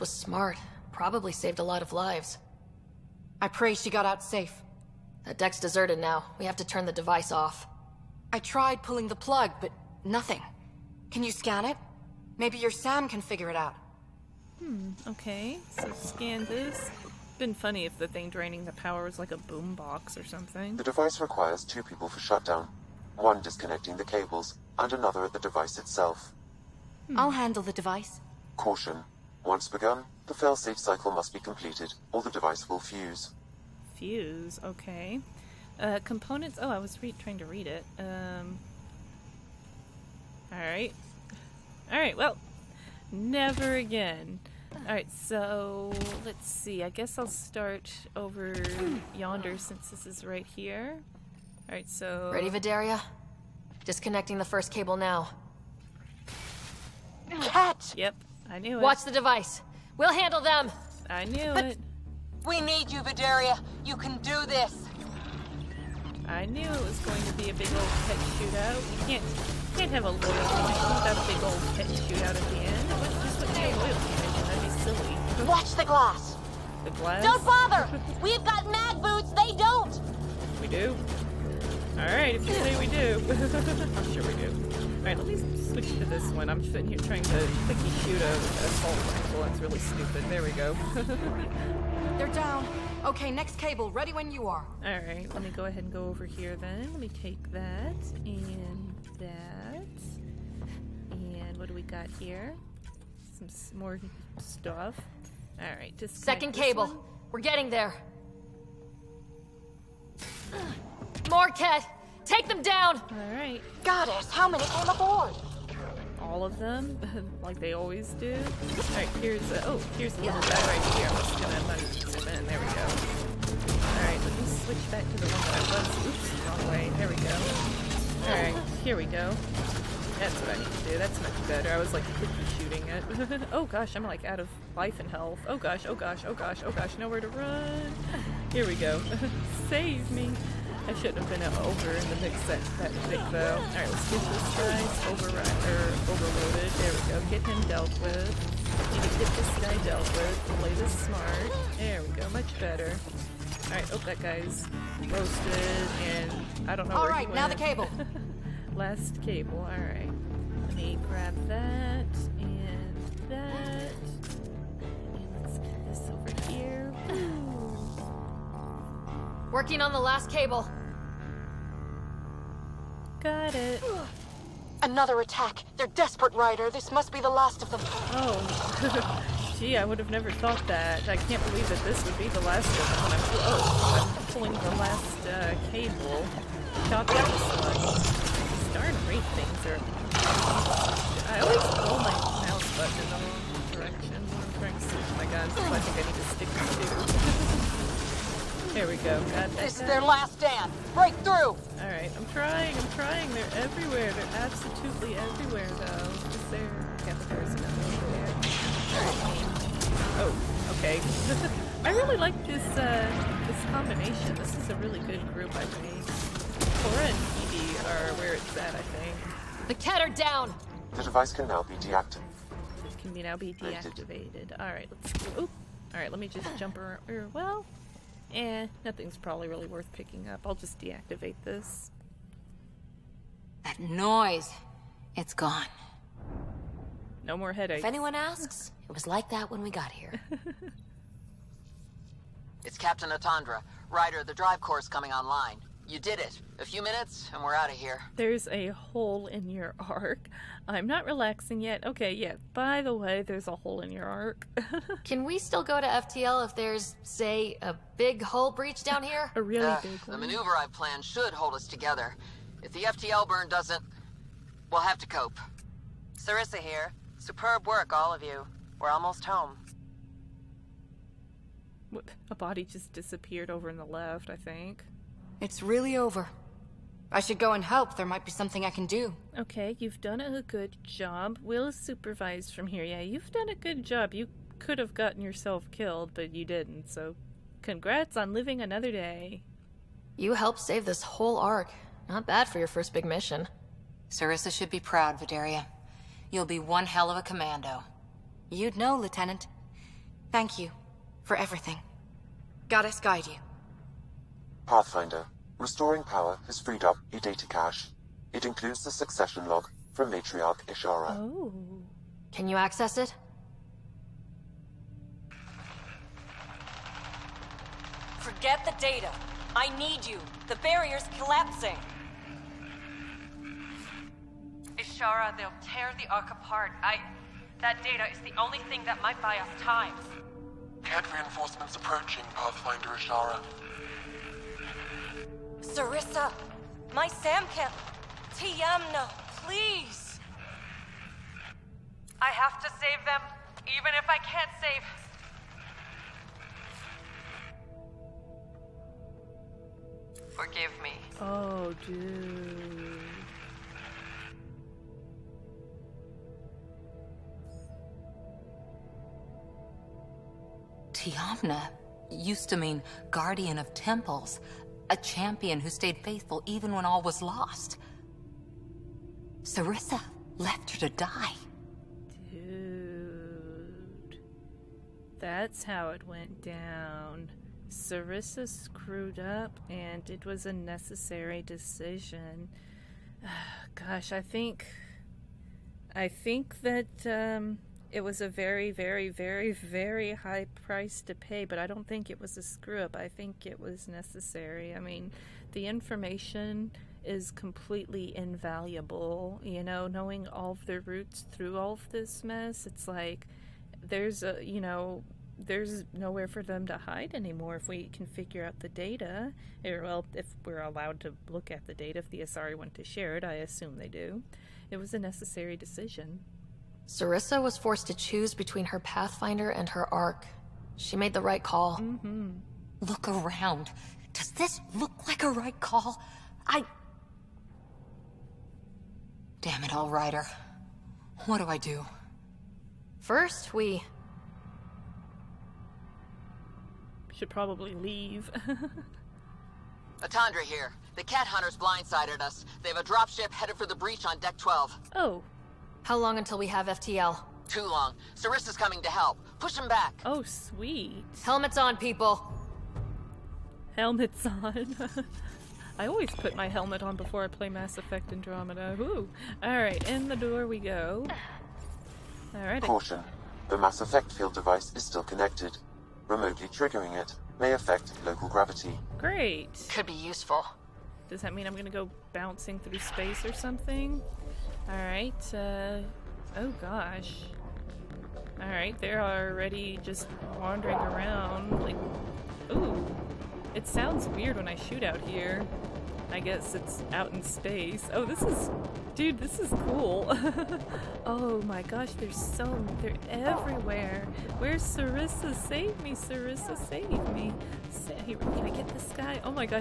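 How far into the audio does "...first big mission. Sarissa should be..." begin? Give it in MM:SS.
04:52.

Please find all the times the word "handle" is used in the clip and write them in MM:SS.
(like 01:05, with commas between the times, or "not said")
00:27, 01:00.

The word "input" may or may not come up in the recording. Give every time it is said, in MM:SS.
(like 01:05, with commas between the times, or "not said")
not said.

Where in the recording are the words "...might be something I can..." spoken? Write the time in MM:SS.
04:38.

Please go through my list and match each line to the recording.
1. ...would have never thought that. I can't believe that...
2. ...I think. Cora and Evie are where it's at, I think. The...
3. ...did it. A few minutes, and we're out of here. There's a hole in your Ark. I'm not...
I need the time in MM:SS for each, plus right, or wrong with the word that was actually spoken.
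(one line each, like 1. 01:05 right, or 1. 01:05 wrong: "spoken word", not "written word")
1. 02:59 right
2. 03:35 right
3. 04:06 right.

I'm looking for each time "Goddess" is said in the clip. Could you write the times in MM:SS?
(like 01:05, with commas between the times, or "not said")
01:53, 05:02.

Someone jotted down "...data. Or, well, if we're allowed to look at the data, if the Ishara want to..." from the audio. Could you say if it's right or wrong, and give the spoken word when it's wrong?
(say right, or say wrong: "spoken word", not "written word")
wrong: "Asari", not "Ishara".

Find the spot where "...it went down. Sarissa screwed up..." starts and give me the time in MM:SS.
06:15.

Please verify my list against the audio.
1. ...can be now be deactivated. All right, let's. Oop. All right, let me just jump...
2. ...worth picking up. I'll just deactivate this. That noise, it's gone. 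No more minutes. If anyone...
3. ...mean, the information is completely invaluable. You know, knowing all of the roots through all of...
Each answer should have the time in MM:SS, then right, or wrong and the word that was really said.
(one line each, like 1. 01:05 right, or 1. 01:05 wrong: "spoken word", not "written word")
1. 03:43 right
2. 03:49 wrong: "headaches", not "minutes"
3. 06:34 right.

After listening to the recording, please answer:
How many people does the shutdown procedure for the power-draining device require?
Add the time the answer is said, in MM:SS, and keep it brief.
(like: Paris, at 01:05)
2, at 00:21.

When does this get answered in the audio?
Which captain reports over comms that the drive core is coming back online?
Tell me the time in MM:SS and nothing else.
04:02.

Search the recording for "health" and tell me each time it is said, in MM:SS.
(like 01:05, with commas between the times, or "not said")
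02:15.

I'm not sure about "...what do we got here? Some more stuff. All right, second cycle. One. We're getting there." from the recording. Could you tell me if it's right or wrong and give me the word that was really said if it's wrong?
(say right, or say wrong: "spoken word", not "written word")
wrong: "cable", not "cycle".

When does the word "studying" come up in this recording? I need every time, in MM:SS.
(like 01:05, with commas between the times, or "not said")
not said.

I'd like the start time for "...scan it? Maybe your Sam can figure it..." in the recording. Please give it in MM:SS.
00:11.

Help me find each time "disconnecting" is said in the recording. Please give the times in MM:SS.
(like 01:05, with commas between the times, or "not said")
00:23, 00:53.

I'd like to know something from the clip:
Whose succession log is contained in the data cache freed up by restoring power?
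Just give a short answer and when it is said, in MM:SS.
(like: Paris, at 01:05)
Matriarch Ishara, at 05:10.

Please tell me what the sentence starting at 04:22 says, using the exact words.
If the FTL burn doesn't, we'll have to cope.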